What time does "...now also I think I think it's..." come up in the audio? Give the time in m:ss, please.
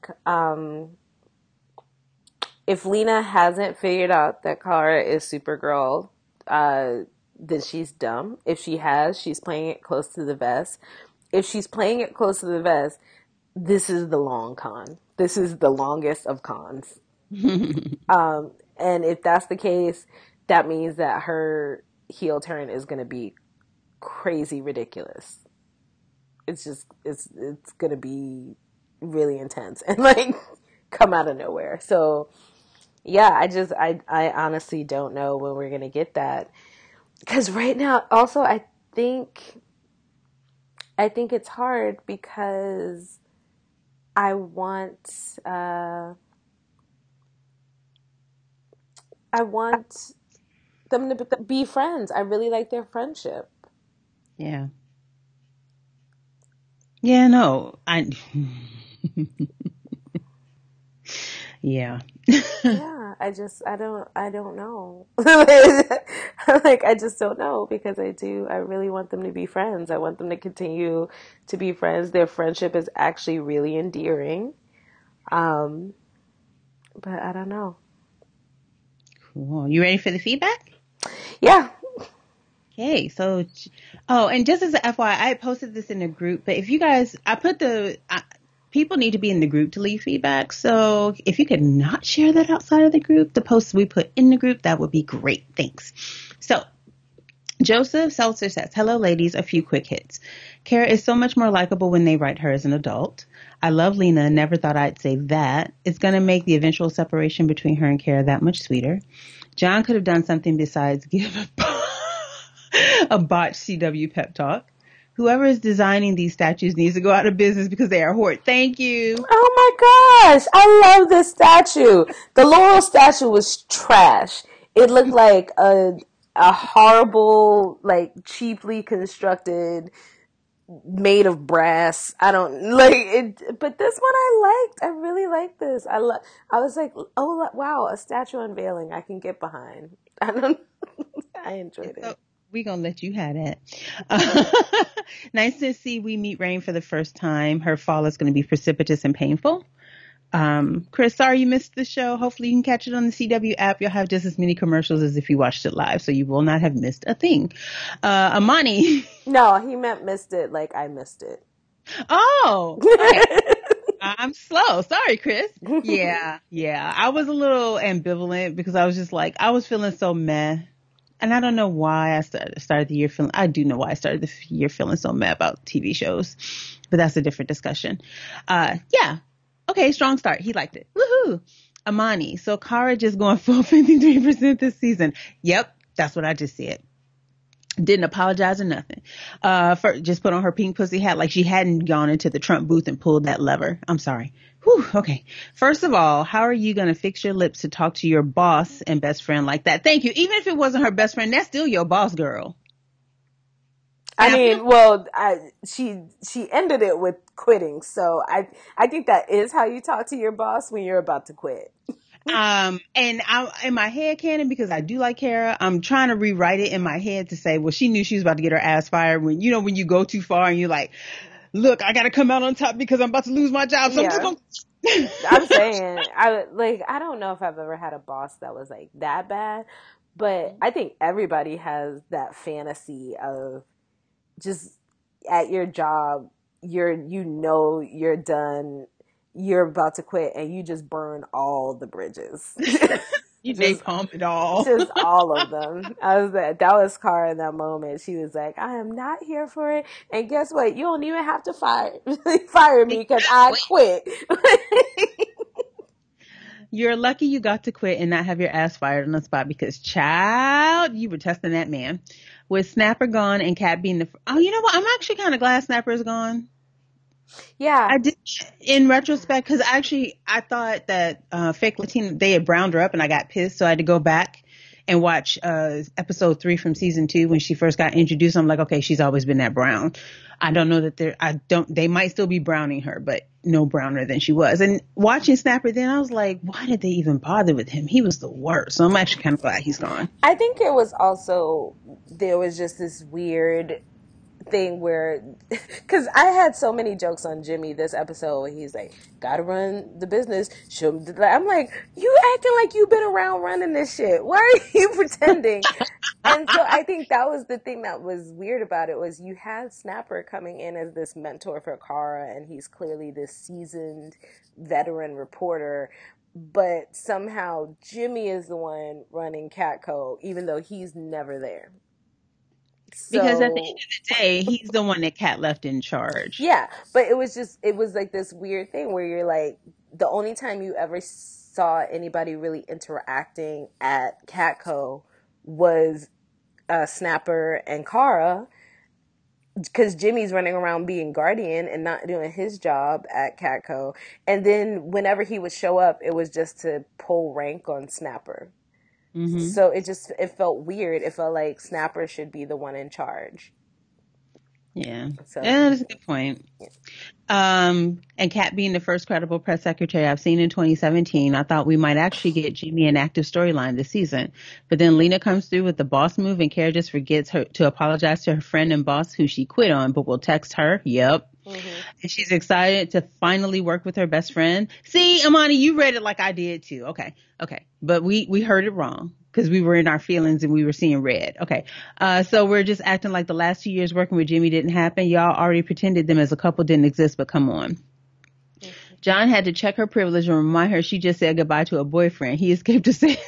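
0:37.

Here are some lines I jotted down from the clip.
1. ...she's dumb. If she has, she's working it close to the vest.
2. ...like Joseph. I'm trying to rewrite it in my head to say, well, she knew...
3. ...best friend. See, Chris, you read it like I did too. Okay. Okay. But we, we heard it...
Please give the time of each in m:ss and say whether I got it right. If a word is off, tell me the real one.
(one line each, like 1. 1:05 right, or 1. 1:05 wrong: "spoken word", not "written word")
1. 0:07 wrong: "playing", not "working"
2. 3:34 wrong: "Kara", not "Joseph"
3. 6:14 wrong: "Amani", not "Chris".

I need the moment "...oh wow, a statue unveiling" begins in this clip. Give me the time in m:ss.
2:17.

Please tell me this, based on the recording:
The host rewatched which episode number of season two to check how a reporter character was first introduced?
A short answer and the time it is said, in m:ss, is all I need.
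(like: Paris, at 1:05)
Episode 3, at 4:35.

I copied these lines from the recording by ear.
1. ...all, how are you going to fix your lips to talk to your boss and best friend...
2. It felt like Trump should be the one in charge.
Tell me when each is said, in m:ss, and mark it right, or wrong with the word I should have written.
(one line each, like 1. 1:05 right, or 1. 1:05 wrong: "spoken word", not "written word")
1. 3:15 right
2. 5:51 wrong: "Snapper", not "Trump".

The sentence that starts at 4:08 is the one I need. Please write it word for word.
She was like, "I am not here for it," and guess what?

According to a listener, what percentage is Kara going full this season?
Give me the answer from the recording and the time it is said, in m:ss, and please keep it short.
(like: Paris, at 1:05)
53%, at 3:03.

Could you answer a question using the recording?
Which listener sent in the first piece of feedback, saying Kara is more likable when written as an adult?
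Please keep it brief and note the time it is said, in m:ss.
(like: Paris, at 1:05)
Joseph Seltzer, at 1:37.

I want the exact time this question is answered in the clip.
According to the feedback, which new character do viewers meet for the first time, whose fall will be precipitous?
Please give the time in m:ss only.
2:26.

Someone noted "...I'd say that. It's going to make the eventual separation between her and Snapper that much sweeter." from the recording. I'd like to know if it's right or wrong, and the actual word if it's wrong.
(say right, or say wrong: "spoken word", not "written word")
wrong: "Kara", not "Snapper".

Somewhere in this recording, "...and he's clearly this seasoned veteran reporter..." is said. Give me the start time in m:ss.
5:12.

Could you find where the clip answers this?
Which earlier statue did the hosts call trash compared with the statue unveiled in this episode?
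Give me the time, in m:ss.
2:02.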